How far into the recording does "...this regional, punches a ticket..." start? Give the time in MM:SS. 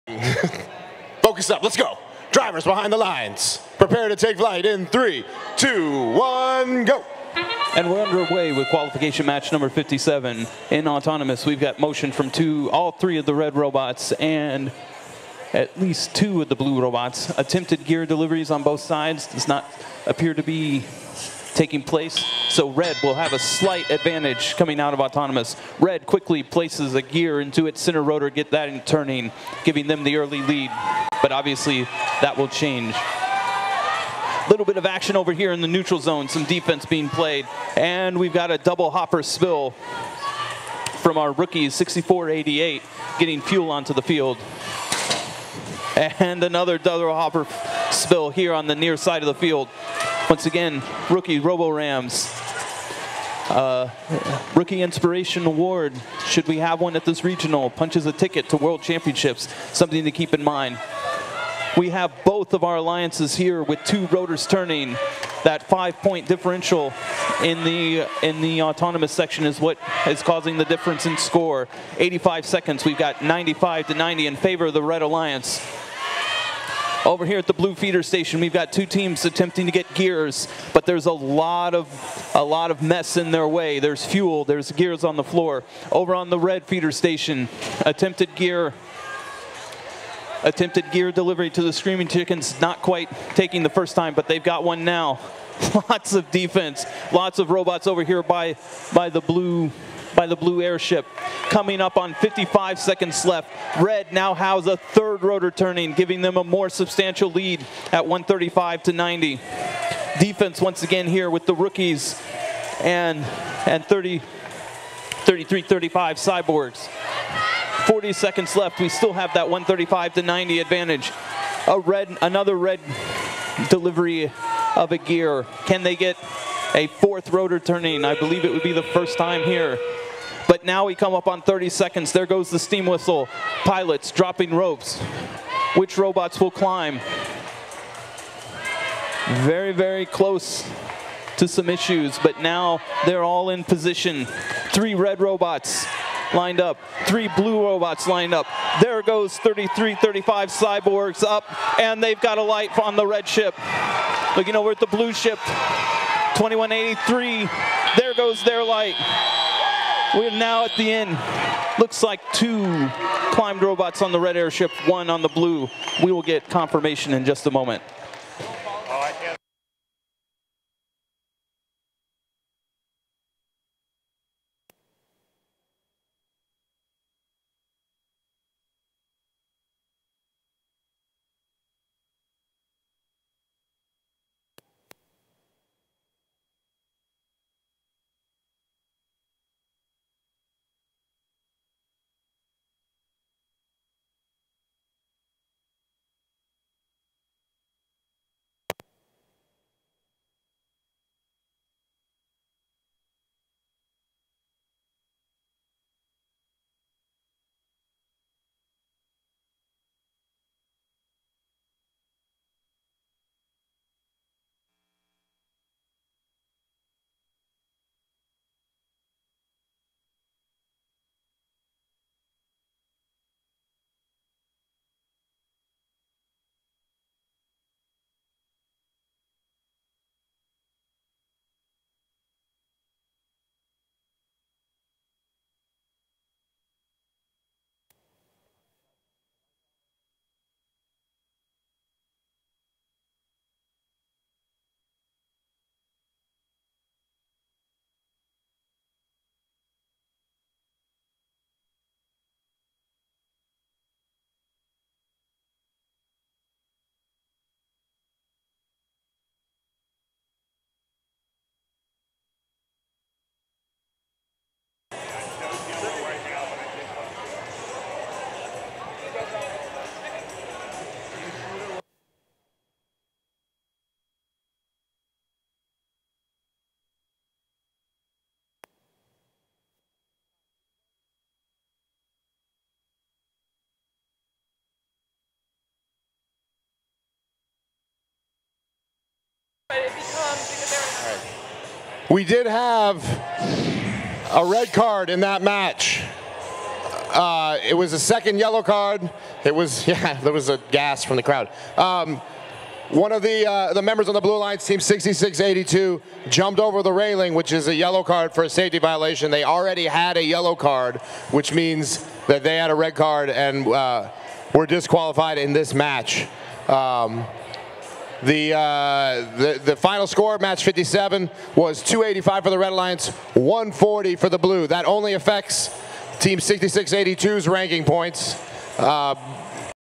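00:57.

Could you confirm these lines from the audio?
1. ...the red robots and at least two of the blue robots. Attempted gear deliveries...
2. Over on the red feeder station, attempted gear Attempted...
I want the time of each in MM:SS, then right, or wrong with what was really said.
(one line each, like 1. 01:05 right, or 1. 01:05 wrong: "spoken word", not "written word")
1. 00:13 right
2. 01:25 right.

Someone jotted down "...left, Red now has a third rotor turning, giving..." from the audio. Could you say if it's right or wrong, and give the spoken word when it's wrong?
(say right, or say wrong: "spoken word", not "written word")
right.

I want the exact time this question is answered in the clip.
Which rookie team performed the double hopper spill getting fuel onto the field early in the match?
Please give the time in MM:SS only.
00:41.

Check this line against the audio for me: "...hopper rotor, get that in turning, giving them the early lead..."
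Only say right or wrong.
wrong.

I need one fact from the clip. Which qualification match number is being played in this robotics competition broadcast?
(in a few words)
57.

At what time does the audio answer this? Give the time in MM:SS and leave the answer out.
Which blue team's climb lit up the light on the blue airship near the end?
02:36.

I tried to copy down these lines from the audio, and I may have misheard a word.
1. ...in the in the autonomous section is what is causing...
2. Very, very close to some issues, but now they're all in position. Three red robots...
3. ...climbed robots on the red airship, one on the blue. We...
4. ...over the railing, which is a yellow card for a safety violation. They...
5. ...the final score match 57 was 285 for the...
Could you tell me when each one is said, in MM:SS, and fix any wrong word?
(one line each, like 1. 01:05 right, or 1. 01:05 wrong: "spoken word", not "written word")
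1. 01:07 right
2. 02:19 right
3. 02:43 right
4. 05:06 right
5. 05:19 right.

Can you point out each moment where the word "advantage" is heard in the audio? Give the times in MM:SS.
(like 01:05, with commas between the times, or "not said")
00:23, 02:00.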